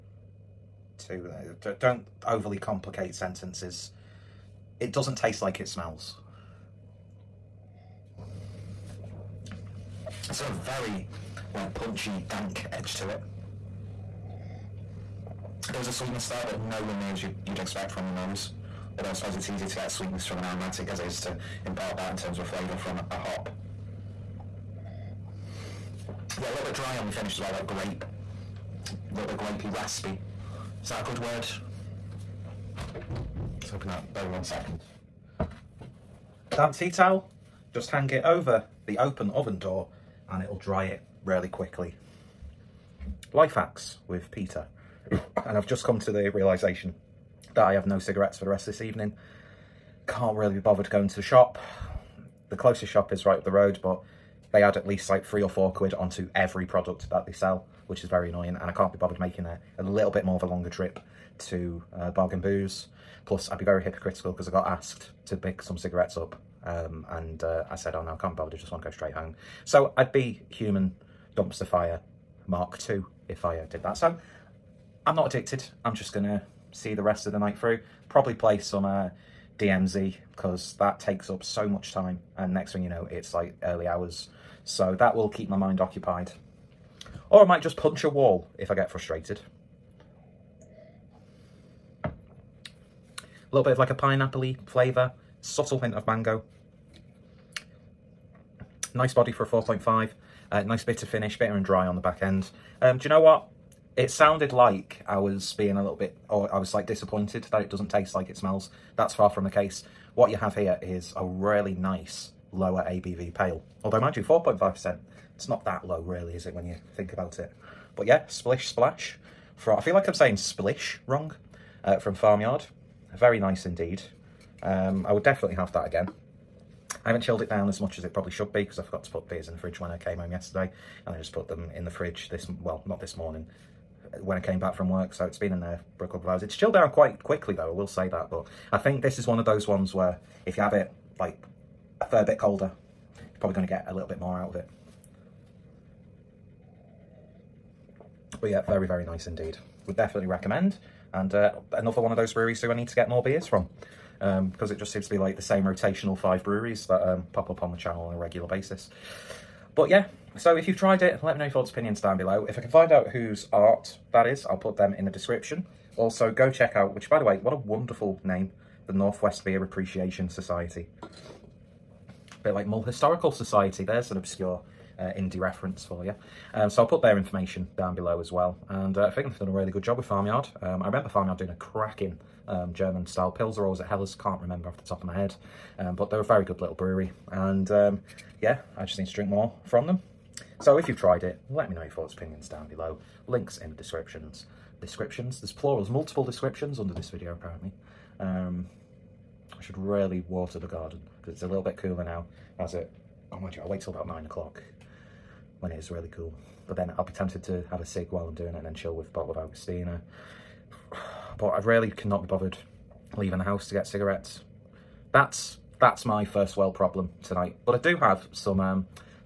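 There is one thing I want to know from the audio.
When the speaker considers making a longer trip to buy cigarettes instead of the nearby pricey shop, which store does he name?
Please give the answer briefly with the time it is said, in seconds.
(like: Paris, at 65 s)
Bargain Booze, at 62 s.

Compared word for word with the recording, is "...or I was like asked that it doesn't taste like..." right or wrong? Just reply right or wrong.
wrong.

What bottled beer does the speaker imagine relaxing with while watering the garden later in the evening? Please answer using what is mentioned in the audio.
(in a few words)
Augustiner.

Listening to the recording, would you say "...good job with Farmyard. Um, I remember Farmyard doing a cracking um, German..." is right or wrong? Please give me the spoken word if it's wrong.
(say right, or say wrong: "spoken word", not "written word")
right.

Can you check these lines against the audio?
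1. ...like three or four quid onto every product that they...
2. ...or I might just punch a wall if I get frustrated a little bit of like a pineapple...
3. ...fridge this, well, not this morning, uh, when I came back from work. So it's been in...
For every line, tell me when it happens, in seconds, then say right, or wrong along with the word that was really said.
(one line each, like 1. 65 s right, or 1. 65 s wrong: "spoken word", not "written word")
1. 55 s right
2. 87 s right
3. 131 s right.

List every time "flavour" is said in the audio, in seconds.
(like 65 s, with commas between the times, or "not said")
22 s, 94 s.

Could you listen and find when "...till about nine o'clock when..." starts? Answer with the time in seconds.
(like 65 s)
203 s.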